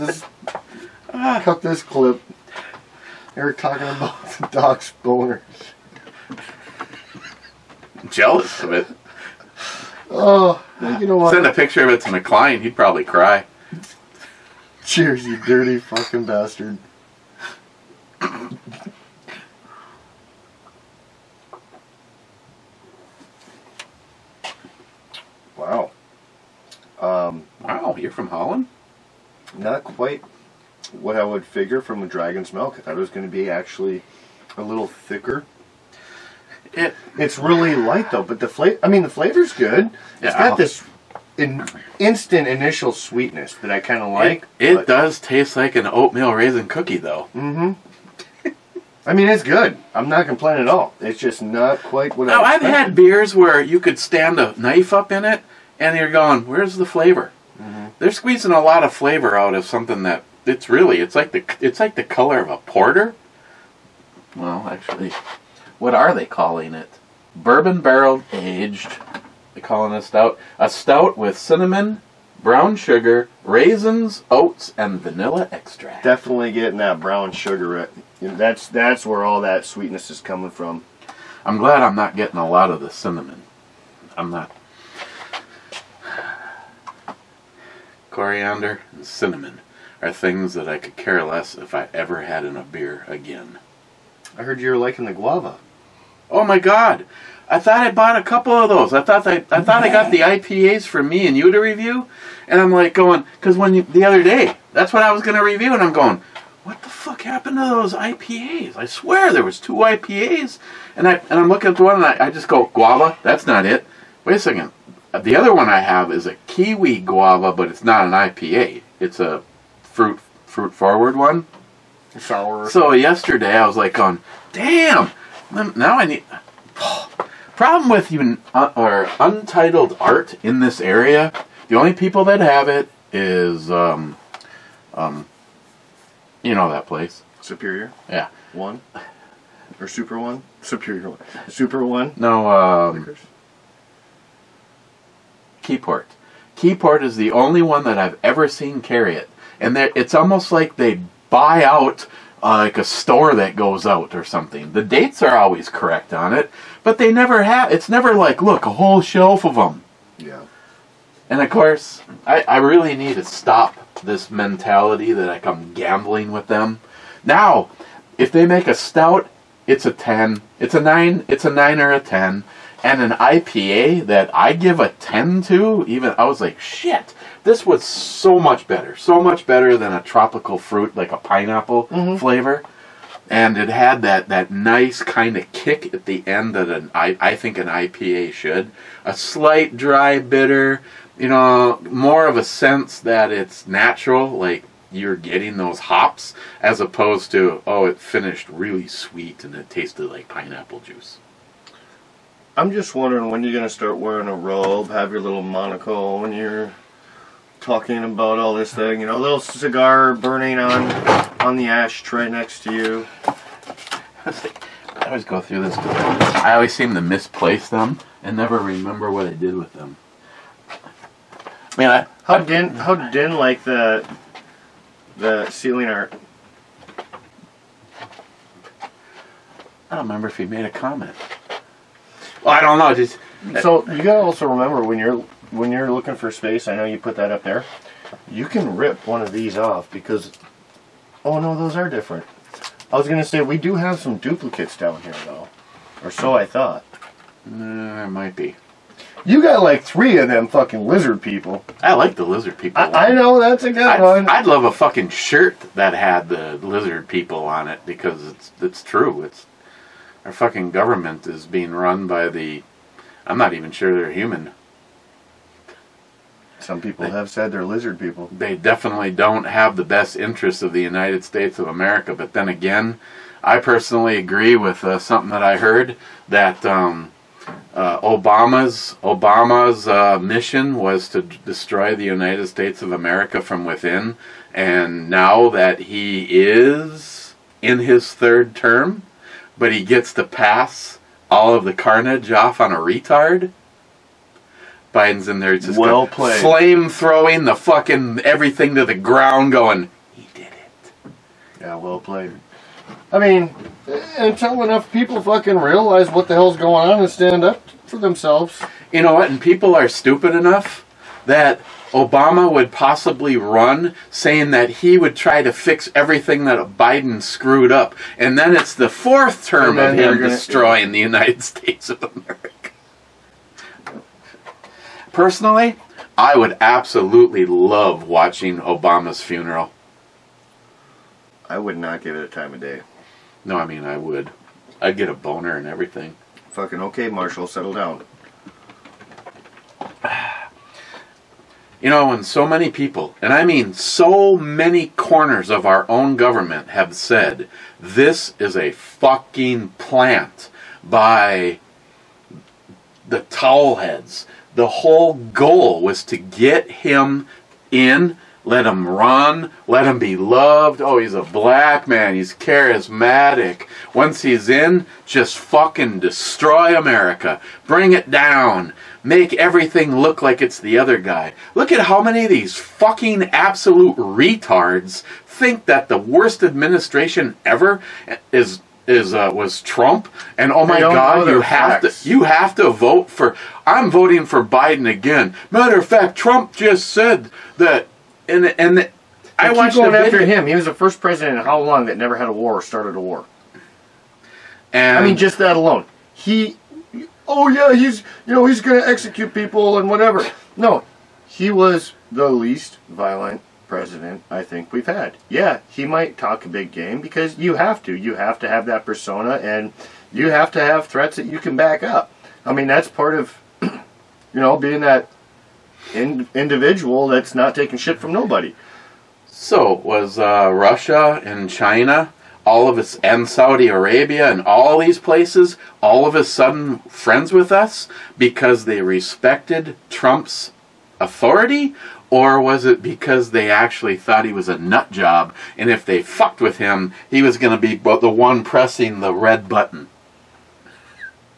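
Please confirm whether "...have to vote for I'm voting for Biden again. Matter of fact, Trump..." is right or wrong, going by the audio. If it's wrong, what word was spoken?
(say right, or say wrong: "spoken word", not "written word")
right.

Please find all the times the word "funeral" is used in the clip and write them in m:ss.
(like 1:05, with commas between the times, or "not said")
5:29.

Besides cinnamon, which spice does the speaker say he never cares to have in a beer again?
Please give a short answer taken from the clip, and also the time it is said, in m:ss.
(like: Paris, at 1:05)
Coriander, at 1:28.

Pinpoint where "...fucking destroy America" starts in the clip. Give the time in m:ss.
6:05.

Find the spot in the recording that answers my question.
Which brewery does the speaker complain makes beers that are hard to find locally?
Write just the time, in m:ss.
2:09.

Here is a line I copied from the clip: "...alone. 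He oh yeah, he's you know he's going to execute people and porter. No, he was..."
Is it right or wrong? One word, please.
wrong.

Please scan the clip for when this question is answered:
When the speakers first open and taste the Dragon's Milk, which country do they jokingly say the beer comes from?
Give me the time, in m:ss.
0:28.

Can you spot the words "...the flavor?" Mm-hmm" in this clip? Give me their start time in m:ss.
0:56.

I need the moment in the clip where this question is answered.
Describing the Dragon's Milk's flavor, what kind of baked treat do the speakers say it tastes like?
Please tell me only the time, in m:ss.
0:45.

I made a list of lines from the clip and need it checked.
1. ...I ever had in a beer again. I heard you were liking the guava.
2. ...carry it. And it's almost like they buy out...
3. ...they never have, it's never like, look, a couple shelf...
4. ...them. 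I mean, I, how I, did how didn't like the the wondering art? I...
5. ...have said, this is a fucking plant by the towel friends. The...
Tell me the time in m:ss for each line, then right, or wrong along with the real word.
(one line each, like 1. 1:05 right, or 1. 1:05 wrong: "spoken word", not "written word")
1. 1:31 right
2. 2:28 right
3. 2:36 wrong: "whole", not "couple"
4. 3:39 wrong: "ceiling", not "wondering"
5. 5:46 wrong: "heads", not "friends".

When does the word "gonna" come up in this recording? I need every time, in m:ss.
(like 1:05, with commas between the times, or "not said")
4:03, 5:20.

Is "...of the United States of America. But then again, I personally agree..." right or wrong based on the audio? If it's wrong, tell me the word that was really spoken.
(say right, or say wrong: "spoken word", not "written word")
right.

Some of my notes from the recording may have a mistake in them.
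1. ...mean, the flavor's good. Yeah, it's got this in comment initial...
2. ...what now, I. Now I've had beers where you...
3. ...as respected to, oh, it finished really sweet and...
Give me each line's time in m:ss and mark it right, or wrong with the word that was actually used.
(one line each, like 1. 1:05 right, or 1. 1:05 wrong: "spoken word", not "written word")
1. 0:38 wrong: "instant", not "comment"
2. 0:52 right
3. 3:16 wrong: "opposed", not "respected".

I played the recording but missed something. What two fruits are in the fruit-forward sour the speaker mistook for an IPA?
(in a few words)
Kiwi guava.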